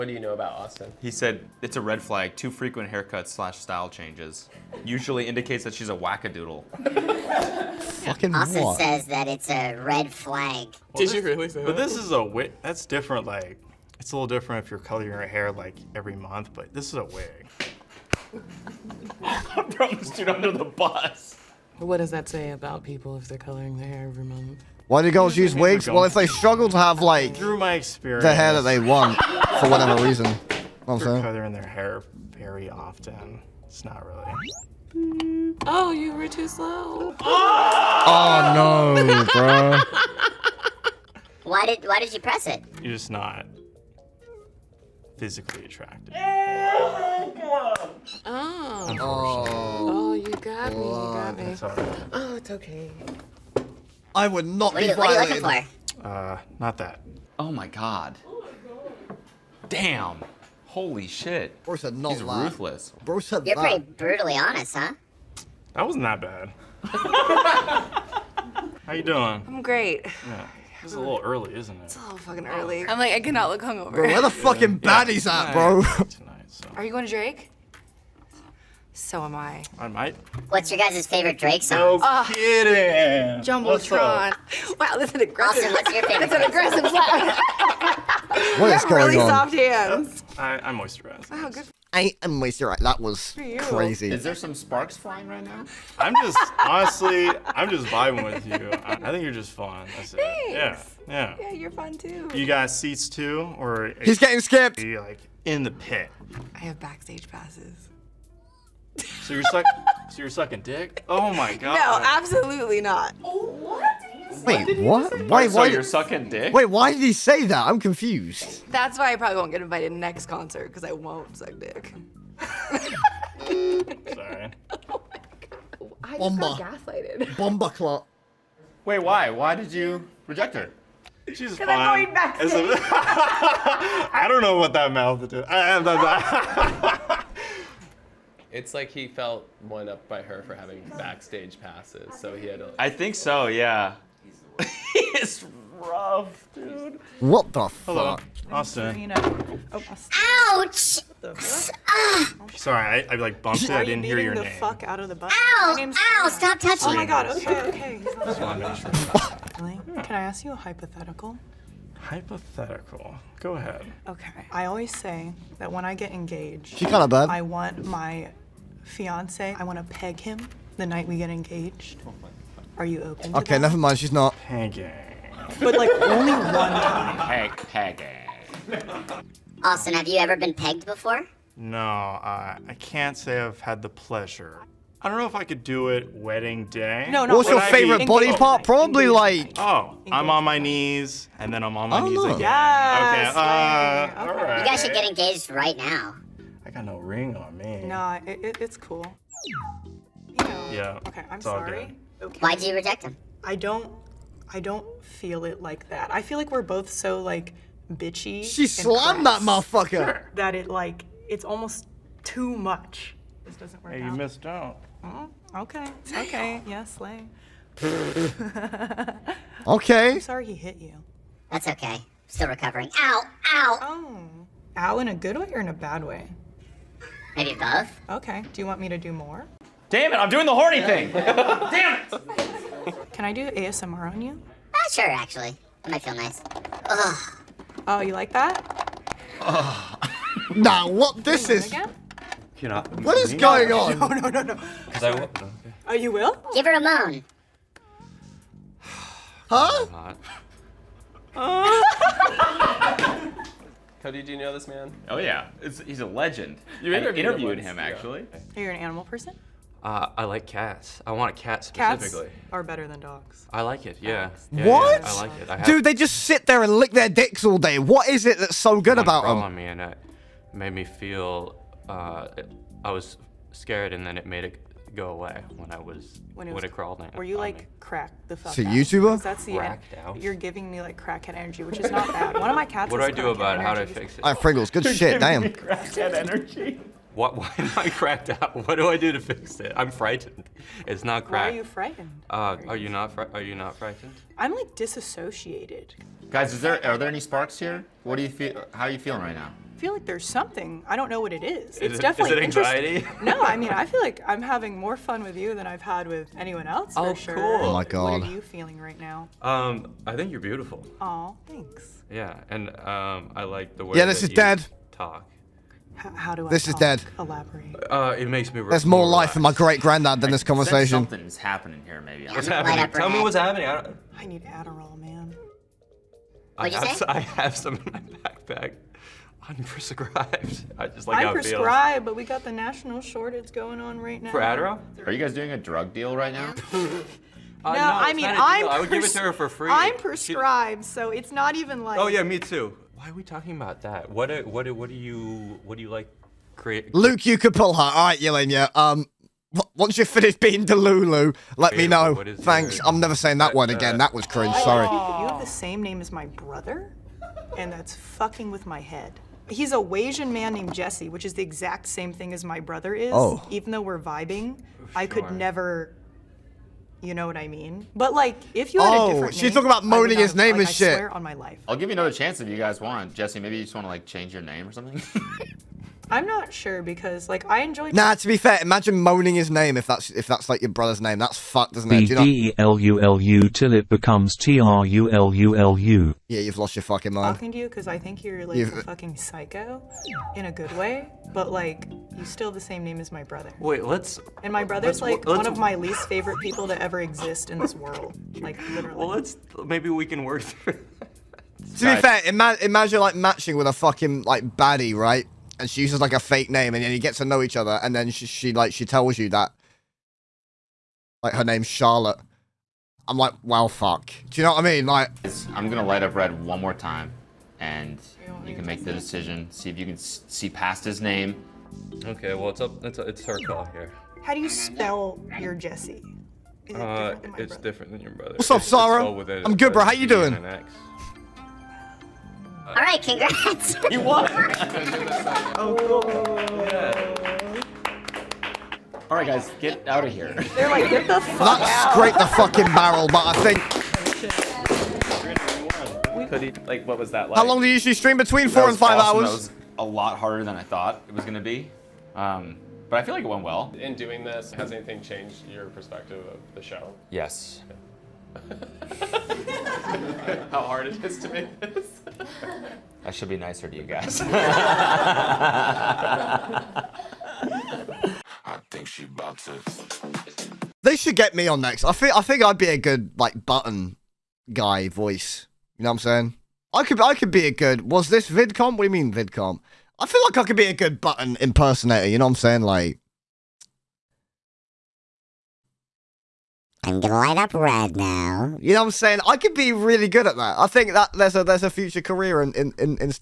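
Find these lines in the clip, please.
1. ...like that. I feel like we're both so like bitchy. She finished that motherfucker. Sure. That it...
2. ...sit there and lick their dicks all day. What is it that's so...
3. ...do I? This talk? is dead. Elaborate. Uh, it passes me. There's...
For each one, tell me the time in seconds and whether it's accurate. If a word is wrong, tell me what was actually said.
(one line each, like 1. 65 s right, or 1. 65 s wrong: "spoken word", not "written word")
1. 205 s wrong: "slammed", not "finished"
2. 266 s right
3. 316 s wrong: "makes", not "passes".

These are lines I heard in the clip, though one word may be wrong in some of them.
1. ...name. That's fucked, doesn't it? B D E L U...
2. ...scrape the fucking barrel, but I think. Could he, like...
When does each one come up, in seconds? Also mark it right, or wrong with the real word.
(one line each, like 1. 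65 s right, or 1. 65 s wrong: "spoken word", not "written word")
1. 381 s right
2. 441 s right.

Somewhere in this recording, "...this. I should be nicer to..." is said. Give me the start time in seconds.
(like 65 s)
461 s.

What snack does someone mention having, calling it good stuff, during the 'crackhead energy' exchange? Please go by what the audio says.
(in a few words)
Pringles.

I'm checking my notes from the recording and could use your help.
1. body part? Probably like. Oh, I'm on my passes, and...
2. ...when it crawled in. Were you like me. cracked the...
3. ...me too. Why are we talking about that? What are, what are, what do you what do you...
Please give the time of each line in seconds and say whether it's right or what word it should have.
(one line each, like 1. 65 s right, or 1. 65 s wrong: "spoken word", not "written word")
1. 188 s wrong: "knees", not "passes"
2. 276 s right
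3. 342 s right.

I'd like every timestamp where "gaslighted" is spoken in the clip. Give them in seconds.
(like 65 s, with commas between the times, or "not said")
126 s.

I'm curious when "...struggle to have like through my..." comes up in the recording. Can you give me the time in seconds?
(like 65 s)
26 s.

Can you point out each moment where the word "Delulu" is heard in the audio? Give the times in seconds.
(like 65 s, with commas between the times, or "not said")
350 s.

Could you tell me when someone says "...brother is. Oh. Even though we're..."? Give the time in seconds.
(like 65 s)
362 s.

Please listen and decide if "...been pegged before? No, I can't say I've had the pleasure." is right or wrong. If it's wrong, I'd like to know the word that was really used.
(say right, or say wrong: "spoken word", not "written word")
right.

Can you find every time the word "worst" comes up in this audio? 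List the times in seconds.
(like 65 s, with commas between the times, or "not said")
not said.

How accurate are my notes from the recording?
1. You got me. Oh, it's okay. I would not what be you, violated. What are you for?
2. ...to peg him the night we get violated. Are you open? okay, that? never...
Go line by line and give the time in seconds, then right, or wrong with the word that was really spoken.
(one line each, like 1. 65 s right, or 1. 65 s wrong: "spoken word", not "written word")
1. 50 s right
2. 169 s wrong: "engaged", not "violated".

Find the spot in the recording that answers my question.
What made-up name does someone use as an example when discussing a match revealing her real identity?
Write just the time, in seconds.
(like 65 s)
411 s.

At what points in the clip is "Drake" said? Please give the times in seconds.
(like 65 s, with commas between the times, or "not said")
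77 s, 81 s.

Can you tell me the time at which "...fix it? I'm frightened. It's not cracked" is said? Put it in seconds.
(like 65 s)
289 s.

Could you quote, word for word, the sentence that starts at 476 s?
I could I could be a good.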